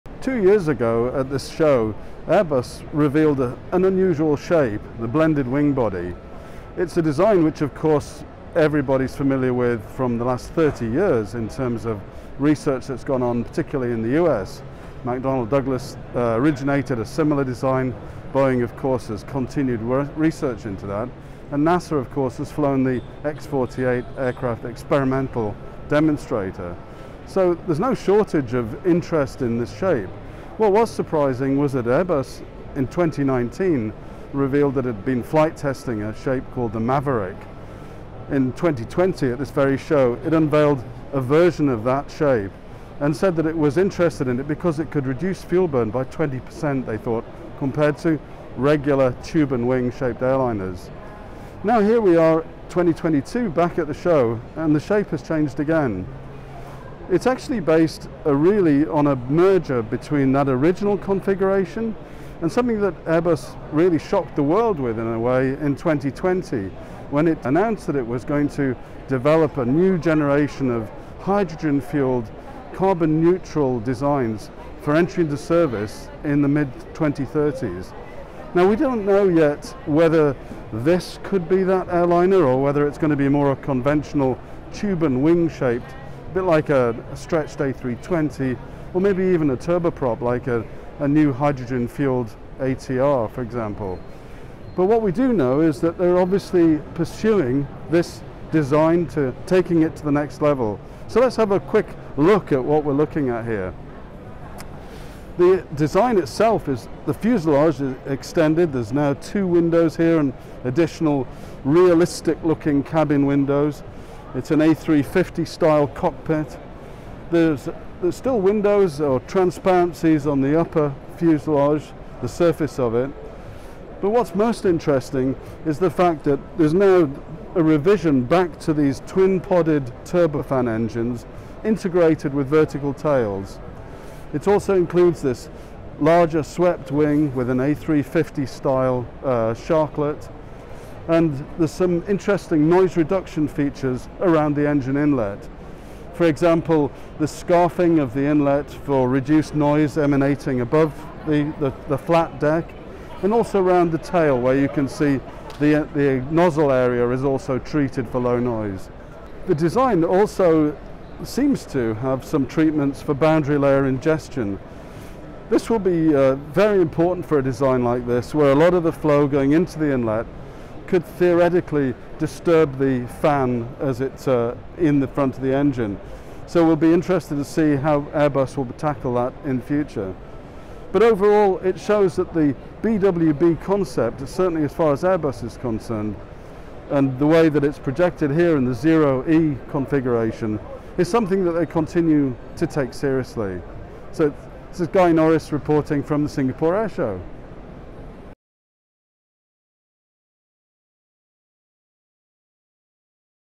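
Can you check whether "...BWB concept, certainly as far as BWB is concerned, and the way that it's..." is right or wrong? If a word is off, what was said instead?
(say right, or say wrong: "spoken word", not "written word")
wrong: "Airbus", not "BWB".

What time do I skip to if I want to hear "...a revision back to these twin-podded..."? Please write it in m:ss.
2:07.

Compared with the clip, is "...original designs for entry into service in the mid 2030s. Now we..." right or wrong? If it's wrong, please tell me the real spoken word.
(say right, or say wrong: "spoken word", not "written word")
wrong: "neutral", not "original".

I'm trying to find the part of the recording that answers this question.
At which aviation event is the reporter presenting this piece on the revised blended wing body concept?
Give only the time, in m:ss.
3:16.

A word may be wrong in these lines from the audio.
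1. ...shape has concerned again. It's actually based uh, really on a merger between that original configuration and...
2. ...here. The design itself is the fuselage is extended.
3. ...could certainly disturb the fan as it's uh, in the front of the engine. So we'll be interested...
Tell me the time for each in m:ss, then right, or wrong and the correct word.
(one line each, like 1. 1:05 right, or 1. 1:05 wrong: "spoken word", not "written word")
1. 0:54 wrong: "changed", not "concerned"
2. 1:43 right
3. 2:50 wrong: "theoretically", not "certainly".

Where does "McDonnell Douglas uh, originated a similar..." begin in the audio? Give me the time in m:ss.
0:15.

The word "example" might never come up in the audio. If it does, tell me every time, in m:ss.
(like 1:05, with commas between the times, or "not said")
1:33, 2:26.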